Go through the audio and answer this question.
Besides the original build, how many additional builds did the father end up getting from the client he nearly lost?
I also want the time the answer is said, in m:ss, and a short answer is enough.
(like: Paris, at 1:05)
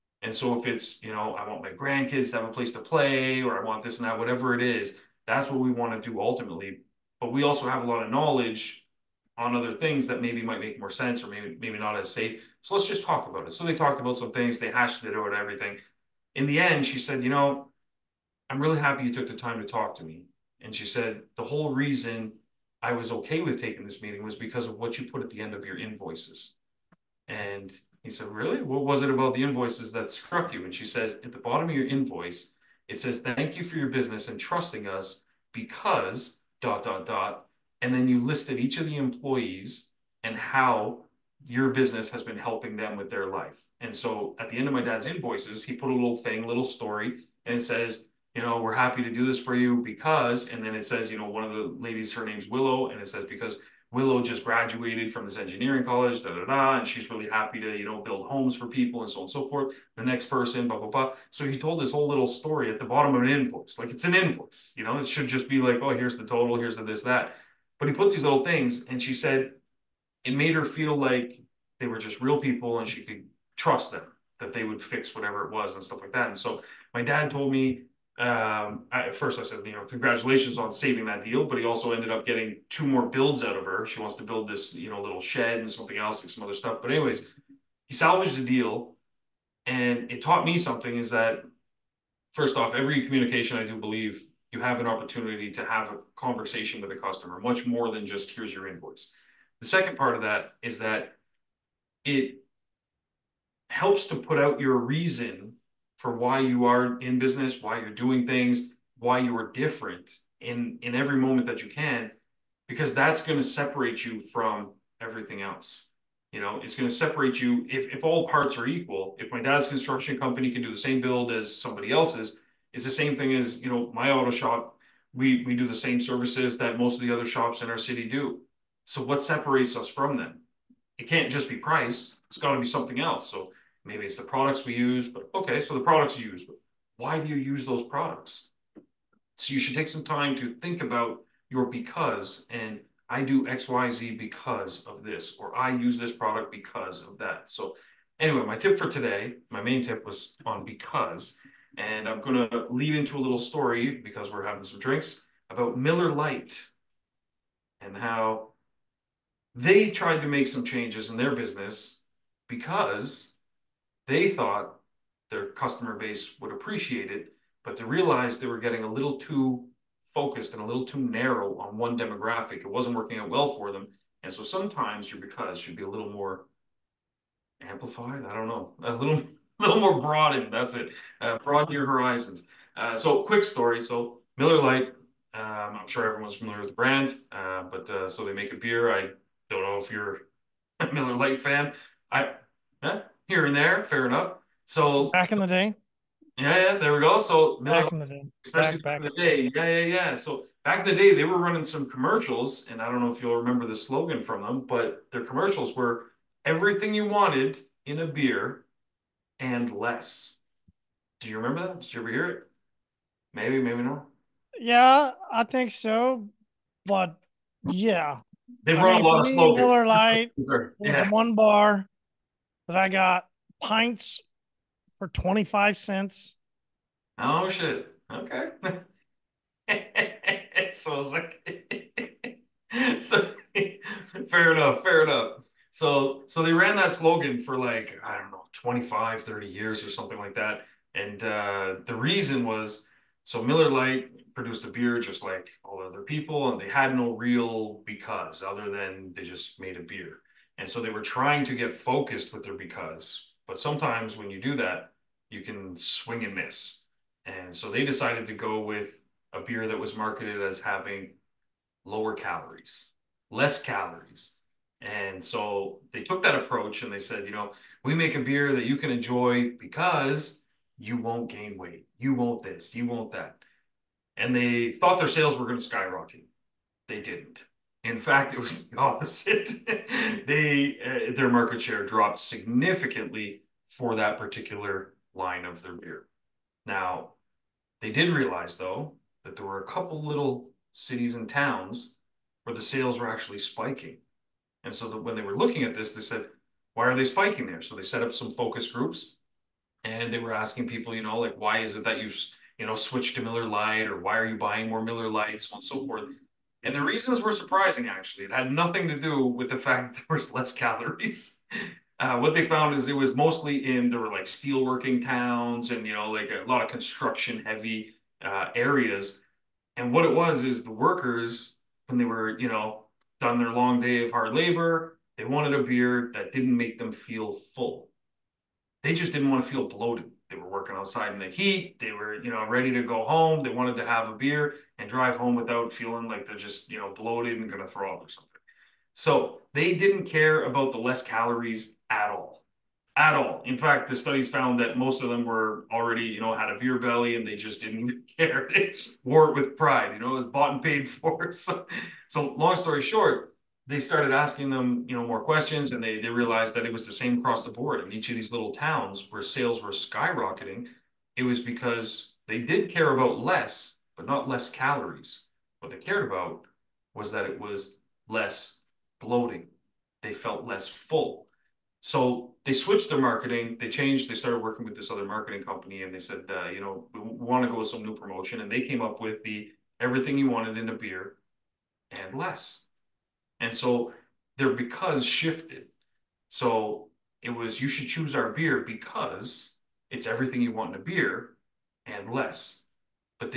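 2, at 1:22.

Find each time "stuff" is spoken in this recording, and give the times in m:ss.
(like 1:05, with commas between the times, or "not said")
1:15, 1:26.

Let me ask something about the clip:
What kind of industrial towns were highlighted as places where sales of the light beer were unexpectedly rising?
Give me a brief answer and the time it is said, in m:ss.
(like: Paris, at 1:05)
steelworking towns, at 5:14.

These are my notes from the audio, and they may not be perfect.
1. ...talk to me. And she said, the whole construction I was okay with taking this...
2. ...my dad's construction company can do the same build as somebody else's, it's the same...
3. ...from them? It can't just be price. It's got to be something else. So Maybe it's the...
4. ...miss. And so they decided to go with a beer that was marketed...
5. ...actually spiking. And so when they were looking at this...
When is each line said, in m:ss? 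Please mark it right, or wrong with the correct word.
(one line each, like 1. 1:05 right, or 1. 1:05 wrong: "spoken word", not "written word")
1. 0:19 wrong: "reason", not "construction"
2. 1:59 right
3. 2:09 right
4. 4:16 right
5. 4:53 right.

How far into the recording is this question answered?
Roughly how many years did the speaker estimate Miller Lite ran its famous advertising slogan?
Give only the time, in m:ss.
3:58.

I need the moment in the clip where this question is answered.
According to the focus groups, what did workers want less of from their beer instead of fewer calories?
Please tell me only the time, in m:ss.
6:08.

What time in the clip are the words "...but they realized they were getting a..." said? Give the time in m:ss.
2:47.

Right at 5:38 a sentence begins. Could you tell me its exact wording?
So they didn't care about the less calories at all.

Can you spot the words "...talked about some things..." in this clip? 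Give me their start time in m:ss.
0:13.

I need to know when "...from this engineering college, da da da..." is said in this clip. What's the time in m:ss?
0:55.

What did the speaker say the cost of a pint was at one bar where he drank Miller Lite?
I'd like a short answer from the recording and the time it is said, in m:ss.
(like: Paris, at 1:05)
25 cents, at 3:45.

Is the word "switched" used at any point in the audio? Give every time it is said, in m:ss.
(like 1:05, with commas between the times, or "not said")
5:02, 6:12.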